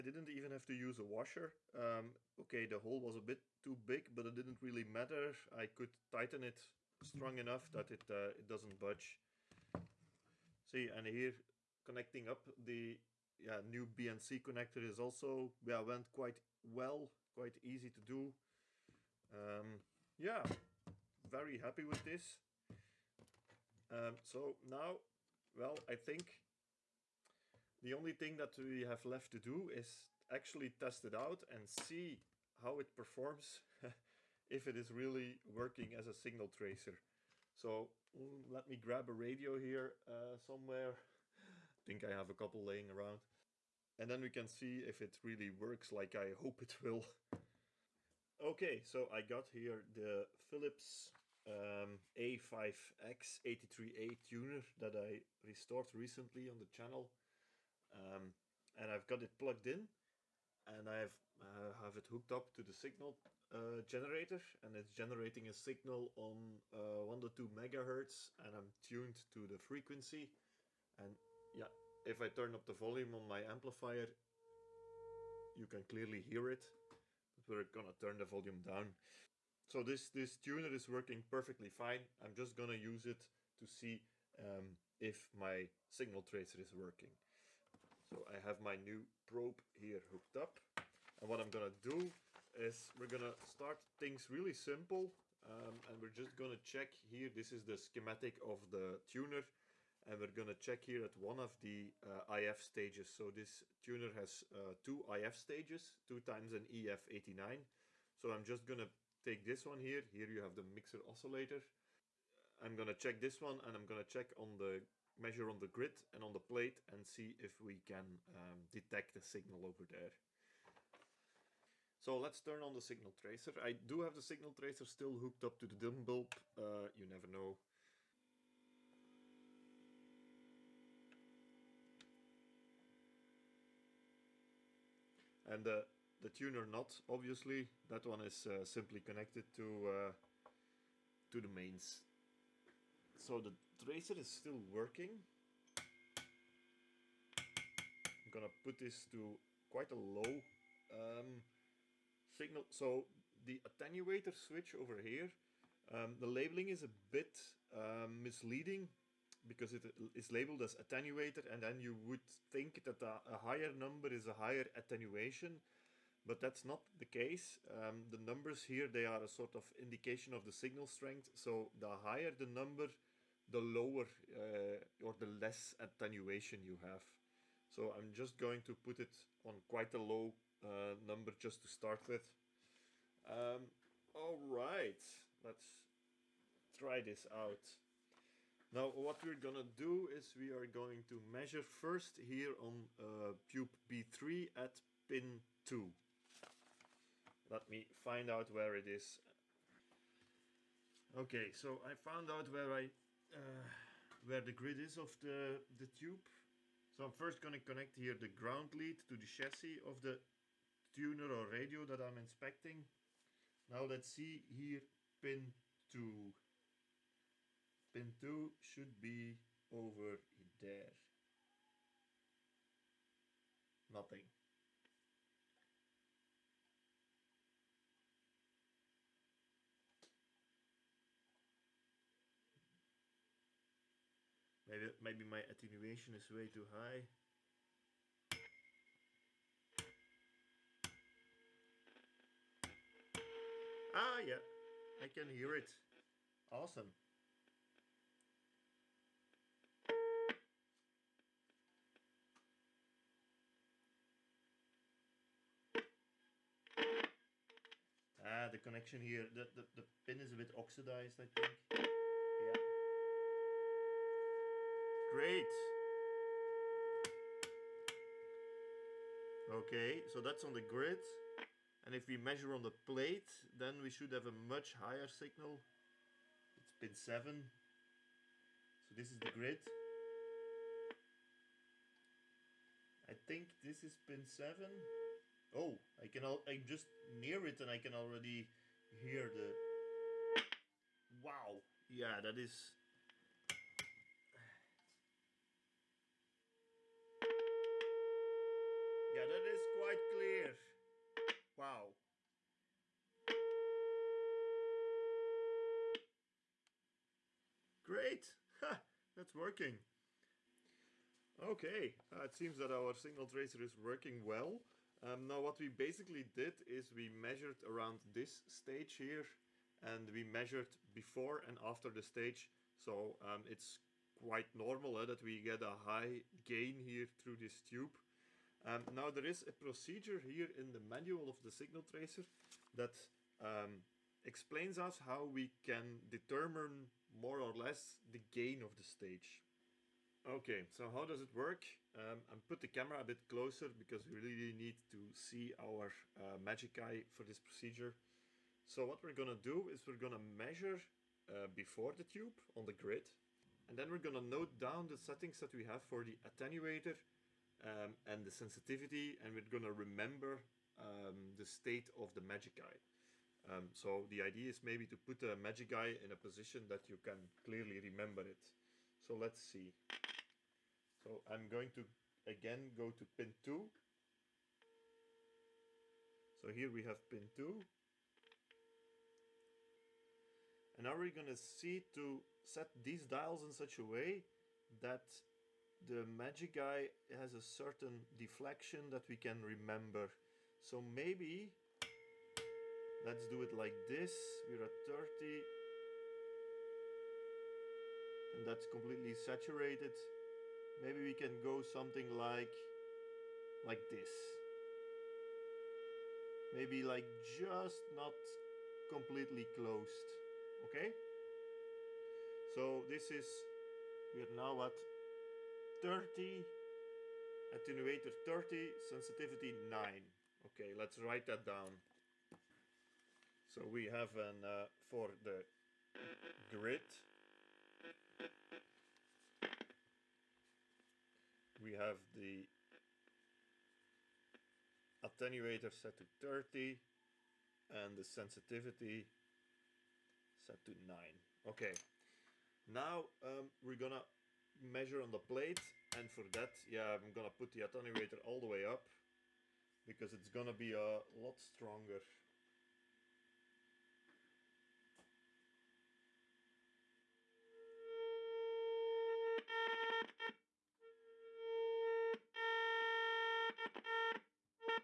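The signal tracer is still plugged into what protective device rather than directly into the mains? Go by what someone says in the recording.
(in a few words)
dim bulb.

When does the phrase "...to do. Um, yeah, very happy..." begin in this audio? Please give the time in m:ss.
0:17.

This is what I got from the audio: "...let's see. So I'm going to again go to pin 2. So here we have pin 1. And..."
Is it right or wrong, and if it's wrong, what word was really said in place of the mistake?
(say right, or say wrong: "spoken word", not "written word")
wrong: "2", not "1".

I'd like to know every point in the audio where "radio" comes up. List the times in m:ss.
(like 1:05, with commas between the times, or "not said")
0:39, 3:31.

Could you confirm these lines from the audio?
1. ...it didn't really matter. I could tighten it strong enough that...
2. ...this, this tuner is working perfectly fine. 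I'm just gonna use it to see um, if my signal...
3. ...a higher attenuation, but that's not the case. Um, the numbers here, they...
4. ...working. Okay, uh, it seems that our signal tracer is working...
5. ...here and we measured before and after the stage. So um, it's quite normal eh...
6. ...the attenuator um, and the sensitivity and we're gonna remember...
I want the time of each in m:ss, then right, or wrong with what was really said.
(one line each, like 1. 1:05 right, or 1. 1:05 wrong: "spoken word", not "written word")
1. 0:04 right
2. 1:19 right
3. 2:44 right
4. 5:09 right
5. 5:18 right
6. 5:56 right.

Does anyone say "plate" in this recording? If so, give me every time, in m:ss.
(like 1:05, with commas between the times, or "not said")
1:56, 4:32, 7:25.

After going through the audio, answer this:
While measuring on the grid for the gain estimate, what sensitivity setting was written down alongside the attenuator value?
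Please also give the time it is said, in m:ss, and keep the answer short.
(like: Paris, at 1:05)
9, at 6:58.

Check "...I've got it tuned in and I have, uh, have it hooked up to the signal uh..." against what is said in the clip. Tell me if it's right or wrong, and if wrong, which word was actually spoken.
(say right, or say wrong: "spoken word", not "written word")
wrong: "plugged", not "tuned".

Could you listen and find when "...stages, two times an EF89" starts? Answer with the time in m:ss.
1:45.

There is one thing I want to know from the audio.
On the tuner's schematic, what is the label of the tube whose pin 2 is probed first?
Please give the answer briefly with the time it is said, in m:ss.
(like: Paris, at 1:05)
B3, at 3:13.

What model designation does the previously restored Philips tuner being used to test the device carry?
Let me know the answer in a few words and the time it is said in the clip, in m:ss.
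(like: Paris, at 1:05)
A5X83A, at 0:52.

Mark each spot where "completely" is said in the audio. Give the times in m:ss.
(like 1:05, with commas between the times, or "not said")
6:38, 6:48.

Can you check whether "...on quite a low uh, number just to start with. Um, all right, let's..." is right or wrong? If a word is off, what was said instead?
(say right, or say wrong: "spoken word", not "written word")
right.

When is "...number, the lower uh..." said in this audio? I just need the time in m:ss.
2:52.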